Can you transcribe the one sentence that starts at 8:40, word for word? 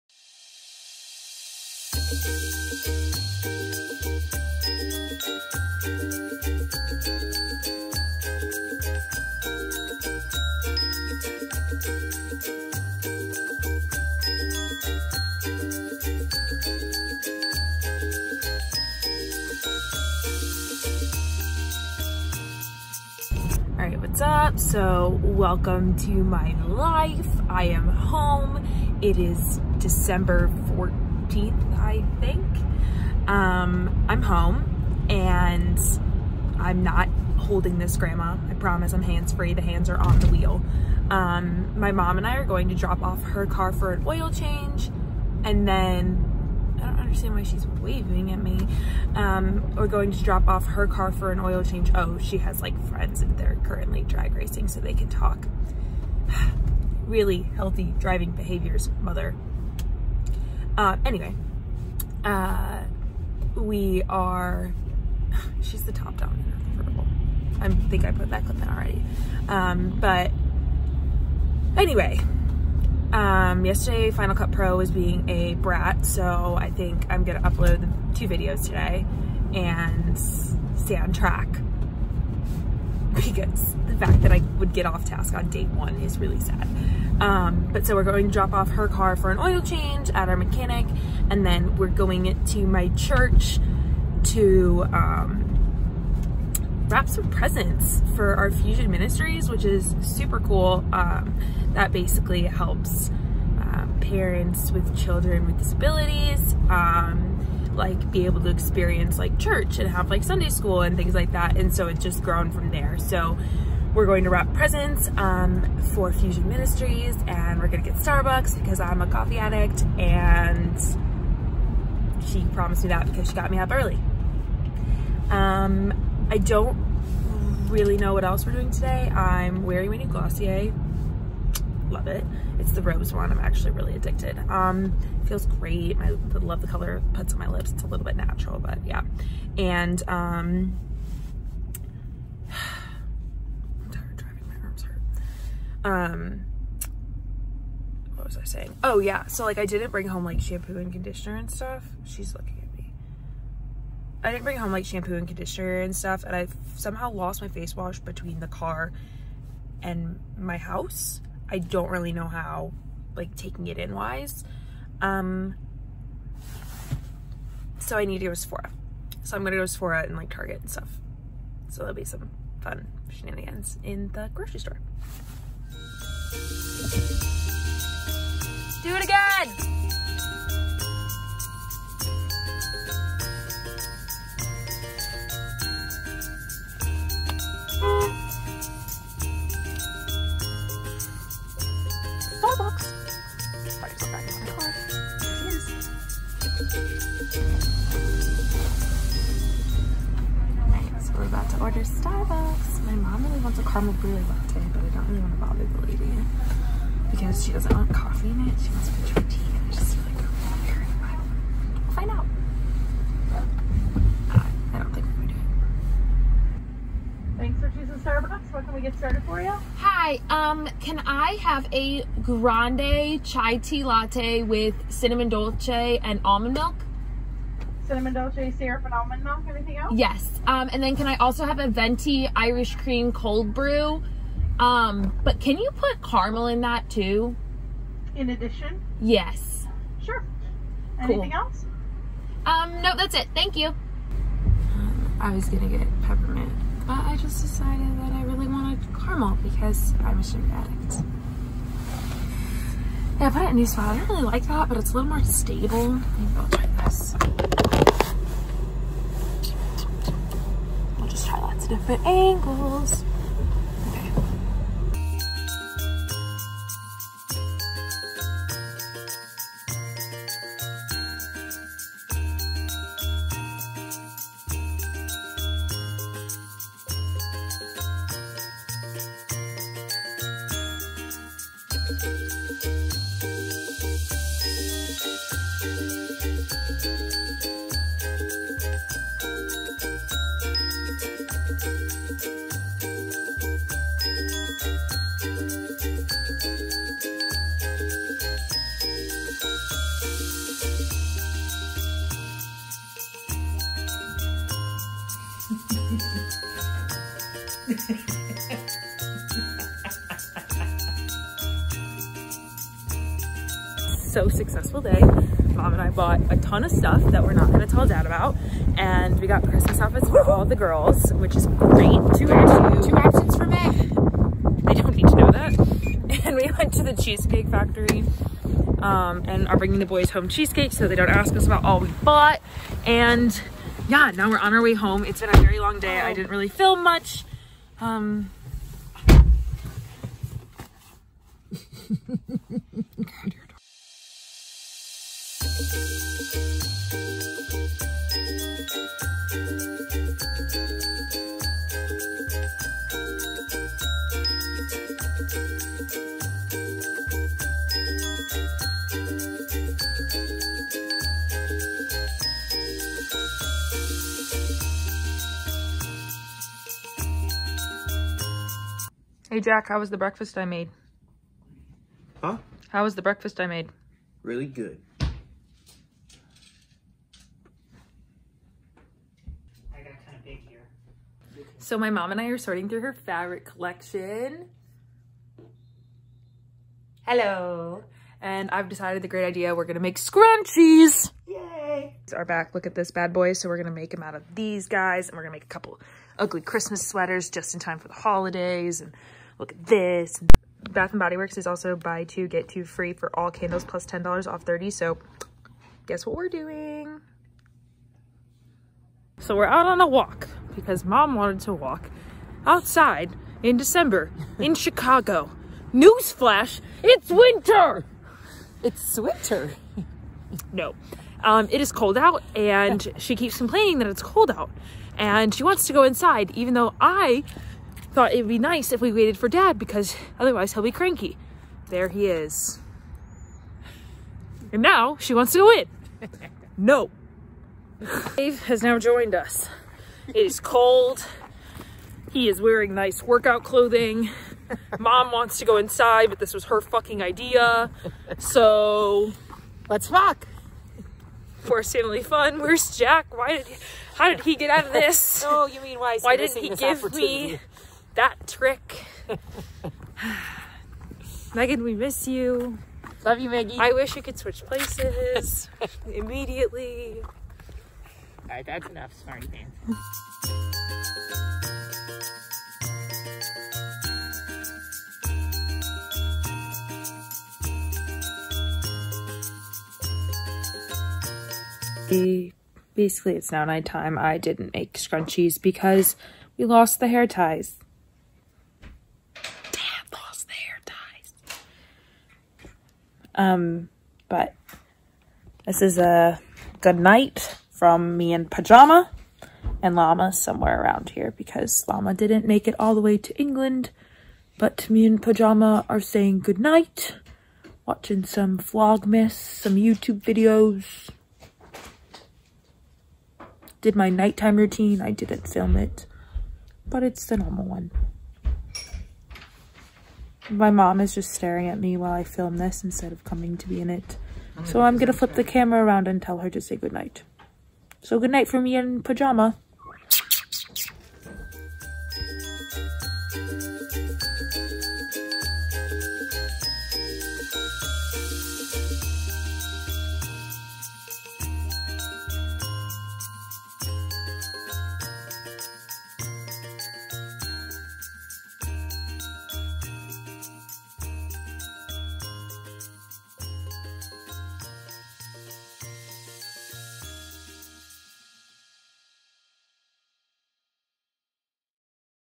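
My mom is just staring at me while I film this instead of coming to be in it.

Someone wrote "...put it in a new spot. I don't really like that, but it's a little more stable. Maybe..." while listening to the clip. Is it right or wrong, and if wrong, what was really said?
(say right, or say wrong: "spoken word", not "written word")
right.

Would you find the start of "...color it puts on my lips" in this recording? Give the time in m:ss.
2:16.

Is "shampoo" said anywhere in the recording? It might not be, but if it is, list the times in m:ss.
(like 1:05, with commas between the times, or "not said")
2:30, 2:34.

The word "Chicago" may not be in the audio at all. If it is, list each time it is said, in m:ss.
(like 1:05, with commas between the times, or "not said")
6:54.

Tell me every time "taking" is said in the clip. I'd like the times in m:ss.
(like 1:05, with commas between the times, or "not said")
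2:43.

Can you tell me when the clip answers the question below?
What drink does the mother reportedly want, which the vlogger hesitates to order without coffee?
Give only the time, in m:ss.
3:23.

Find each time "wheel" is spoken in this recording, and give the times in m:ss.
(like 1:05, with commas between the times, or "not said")
0:40.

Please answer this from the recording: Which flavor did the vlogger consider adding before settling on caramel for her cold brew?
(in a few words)
peppermint.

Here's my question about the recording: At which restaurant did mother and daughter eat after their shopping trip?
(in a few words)
Cheesecake Factory.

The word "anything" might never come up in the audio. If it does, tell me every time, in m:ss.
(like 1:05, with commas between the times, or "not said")
3:49, 4:00.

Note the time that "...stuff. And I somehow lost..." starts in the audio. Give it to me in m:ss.
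2:35.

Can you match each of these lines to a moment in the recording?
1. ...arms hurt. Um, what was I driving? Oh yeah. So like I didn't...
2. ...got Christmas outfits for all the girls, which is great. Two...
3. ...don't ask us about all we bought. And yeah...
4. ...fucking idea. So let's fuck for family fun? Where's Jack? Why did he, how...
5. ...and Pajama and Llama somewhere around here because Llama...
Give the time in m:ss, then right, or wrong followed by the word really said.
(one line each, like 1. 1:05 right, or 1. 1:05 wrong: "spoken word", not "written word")
1. 2:24 wrong: "saying", not "driving"
2. 5:19 right
3. 5:30 right
4. 7:26 right
5. 8:18 right.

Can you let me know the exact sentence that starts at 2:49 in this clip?
So I'm gonna go to Sephora and like Target and stuff.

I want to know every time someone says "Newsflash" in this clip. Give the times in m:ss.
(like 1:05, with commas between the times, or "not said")
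6:55.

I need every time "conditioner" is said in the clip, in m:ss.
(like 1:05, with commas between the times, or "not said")
2:30, 2:35.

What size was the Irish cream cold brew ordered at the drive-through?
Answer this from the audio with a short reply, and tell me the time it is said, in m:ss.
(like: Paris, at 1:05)
venti, at 3:51.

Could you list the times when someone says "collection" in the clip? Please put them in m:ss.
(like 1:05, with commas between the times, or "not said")
6:23.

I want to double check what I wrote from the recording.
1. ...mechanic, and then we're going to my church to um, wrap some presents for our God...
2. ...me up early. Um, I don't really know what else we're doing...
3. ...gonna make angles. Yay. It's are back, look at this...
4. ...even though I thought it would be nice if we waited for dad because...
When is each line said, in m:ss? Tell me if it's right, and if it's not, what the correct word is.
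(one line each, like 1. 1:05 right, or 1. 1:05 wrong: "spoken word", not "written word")
1. 1:30 wrong: "Fusion", not "God"
2. 2:03 right
3. 6:29 wrong: "scrunchies", not "angles"
4. 7:06 right.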